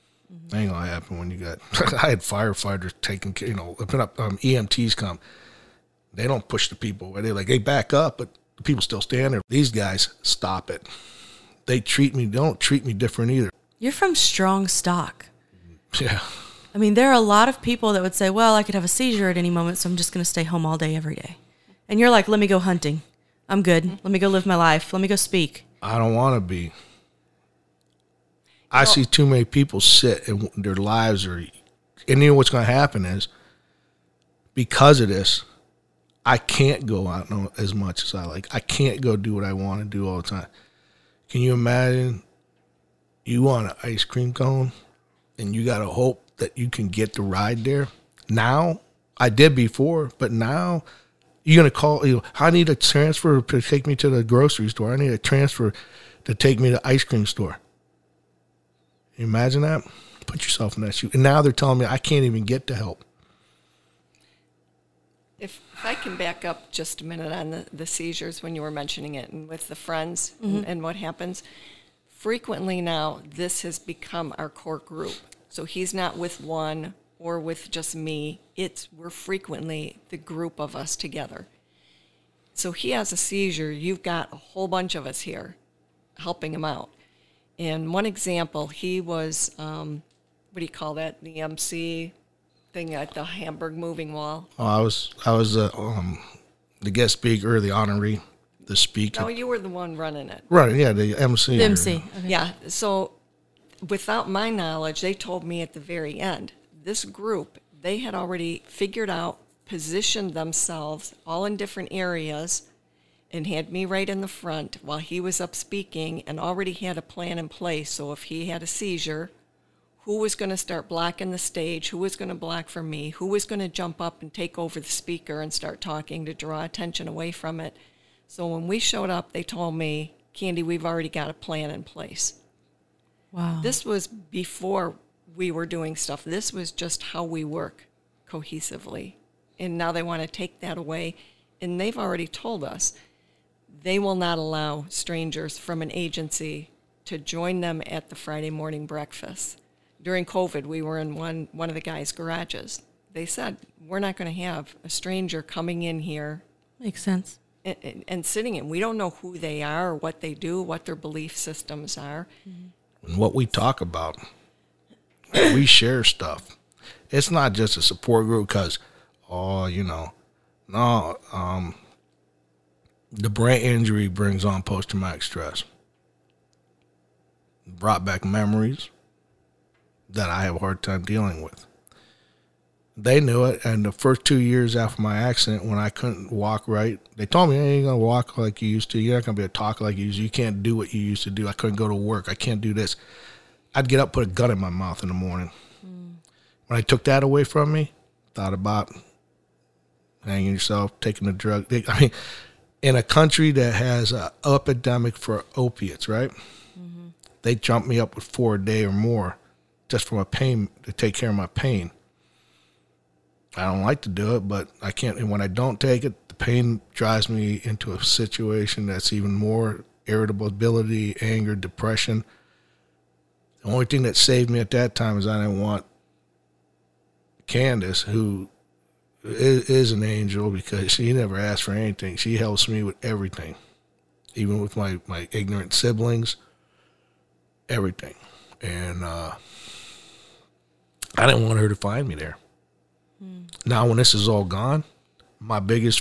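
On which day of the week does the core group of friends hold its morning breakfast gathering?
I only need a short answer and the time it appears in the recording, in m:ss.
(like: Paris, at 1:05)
Friday, at 2:28.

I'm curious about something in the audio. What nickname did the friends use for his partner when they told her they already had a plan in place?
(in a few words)
Candy.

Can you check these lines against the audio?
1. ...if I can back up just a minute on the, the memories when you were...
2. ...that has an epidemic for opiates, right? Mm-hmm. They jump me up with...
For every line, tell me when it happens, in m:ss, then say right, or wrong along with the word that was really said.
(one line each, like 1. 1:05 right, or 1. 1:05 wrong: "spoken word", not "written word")
1. 1:05 wrong: "seizures", not "memories"
2. 3:23 right.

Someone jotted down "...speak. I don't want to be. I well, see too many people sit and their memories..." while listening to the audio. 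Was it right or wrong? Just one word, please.
wrong.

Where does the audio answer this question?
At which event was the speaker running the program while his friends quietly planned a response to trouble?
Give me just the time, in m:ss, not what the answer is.
1:33.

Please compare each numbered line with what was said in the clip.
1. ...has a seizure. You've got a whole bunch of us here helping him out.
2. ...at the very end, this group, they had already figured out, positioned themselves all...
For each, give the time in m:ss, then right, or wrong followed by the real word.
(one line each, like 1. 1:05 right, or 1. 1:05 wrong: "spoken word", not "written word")
1. 1:22 right
2. 1:45 right.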